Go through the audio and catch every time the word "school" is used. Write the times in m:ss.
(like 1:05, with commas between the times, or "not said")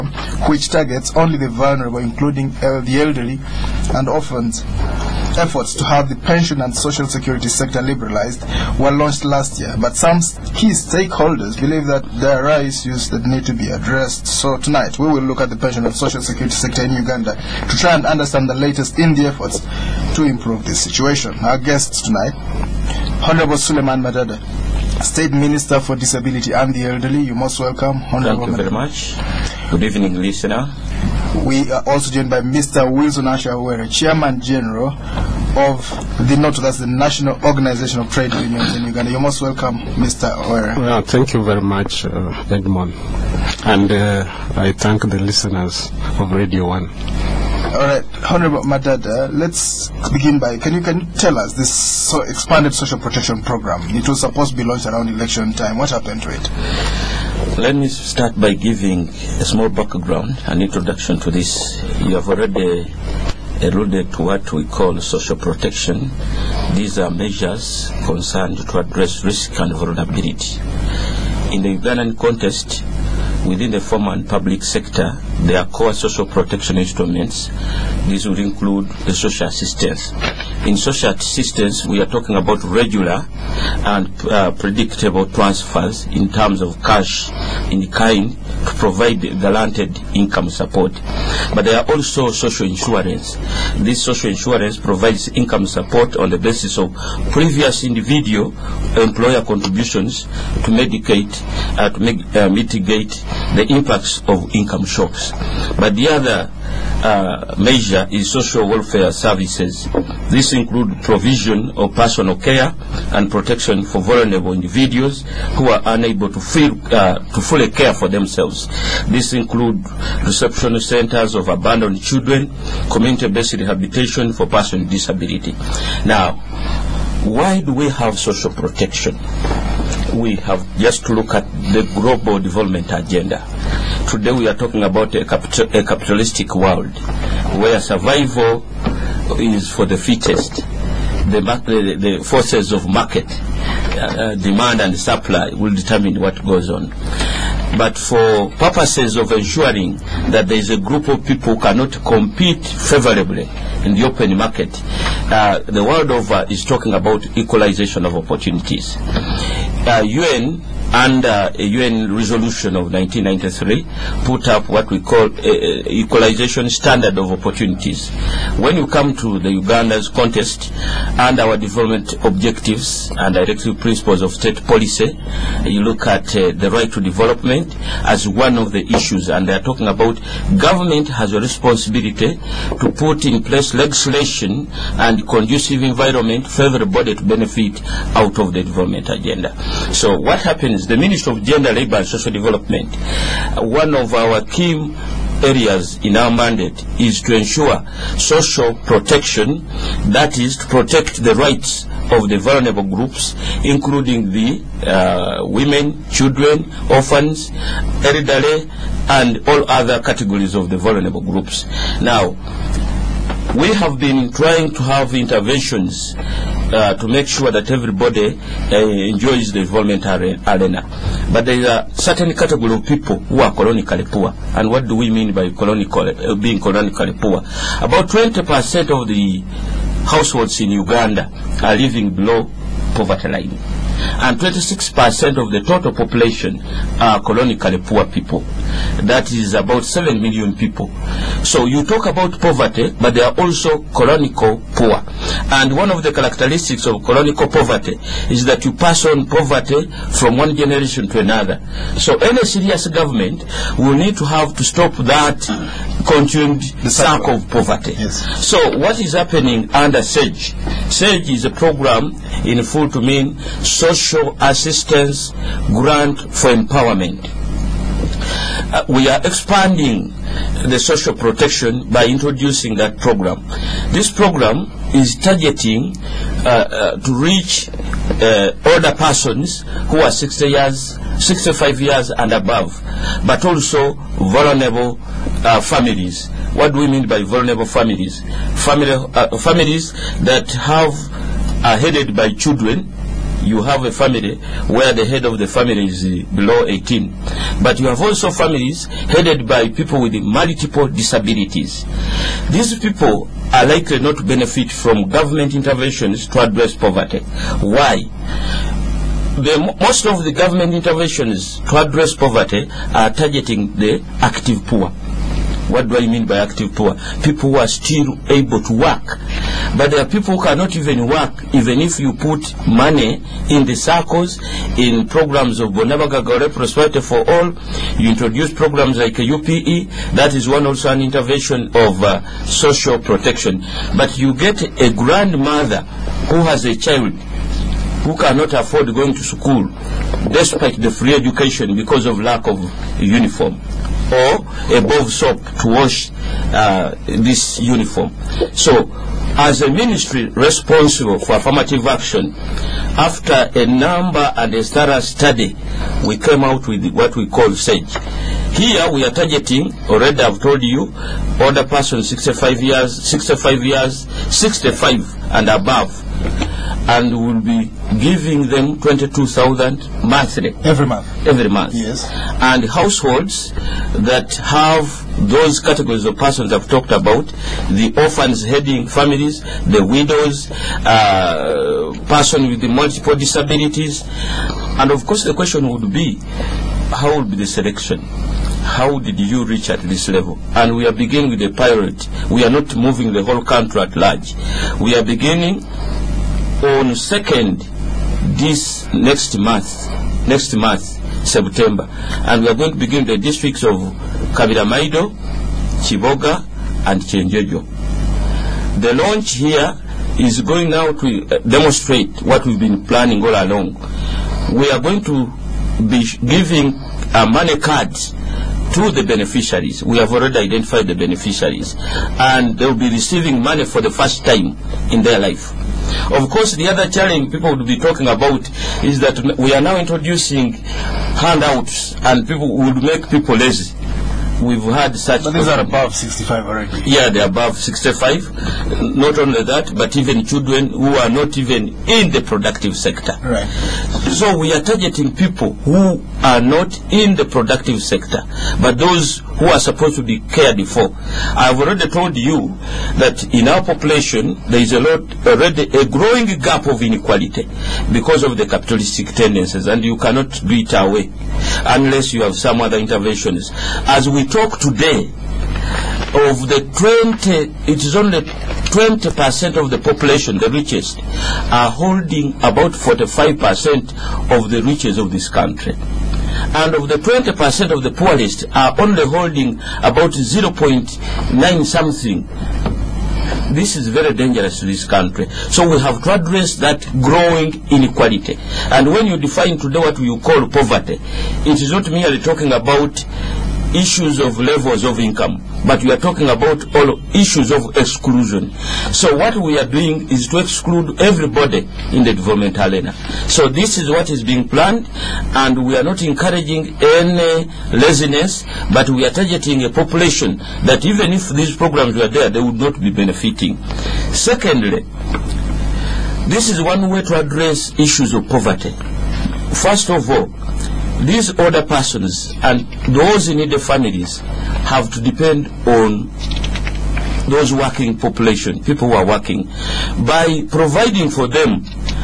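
5:39.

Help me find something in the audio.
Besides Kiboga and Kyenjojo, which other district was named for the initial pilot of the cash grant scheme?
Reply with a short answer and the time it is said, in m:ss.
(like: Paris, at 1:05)
Kabira Maido, at 6:44.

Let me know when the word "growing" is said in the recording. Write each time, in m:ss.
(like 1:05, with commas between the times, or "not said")
7:35, 8:07.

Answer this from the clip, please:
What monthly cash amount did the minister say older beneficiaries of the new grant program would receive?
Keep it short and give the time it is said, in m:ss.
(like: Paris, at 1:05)
22,000, at 6:08.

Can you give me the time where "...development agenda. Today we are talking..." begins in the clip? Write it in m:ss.
2:12.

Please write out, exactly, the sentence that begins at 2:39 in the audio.
UN uh, under a UN resolution of 1993 put up what we call a, a equalization standard of opportunities.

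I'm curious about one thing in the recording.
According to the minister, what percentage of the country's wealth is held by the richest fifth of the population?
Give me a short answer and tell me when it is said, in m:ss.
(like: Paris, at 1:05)
45%, at 7:52.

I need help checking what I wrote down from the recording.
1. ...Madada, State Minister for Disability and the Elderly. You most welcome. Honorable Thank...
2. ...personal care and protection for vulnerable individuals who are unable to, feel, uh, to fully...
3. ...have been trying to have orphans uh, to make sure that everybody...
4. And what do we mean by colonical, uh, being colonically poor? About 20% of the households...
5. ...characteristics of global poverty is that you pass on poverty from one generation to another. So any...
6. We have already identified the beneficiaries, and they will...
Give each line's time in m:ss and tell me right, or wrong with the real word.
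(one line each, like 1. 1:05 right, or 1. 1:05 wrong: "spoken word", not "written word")
1. 0:24 right
2. 1:51 right
3. 3:33 wrong: "interventions", not "orphans"
4. 3:44 right
5. 4:06 wrong: "chronical", not "global"
6. 6:59 right.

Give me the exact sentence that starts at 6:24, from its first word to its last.
And of course the question would be, how will be the selection?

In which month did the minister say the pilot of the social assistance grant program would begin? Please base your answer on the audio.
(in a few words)
September.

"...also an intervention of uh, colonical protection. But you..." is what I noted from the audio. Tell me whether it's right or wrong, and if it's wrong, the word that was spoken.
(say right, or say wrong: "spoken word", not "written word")
wrong: "social", not "colonical".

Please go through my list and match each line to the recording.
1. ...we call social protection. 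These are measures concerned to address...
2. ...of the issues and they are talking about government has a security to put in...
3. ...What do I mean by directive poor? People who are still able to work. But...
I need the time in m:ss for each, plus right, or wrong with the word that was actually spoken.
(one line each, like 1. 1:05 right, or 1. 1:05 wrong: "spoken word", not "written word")
1. 1:04 right
2. 2:58 wrong: "responsibility", not "security"
3. 5:15 wrong: "active", not "directive".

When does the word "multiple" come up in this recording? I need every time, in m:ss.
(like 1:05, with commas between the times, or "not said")
5:00, 6:22.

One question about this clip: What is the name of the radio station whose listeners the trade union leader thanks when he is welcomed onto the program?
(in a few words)
Radio 1.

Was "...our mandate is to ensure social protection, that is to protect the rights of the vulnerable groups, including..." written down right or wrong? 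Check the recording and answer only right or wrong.
right.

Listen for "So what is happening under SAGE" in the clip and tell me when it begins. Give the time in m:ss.
4:18.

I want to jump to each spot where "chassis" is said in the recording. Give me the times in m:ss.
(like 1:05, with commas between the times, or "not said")
not said.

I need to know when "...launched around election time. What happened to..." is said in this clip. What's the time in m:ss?
0:54.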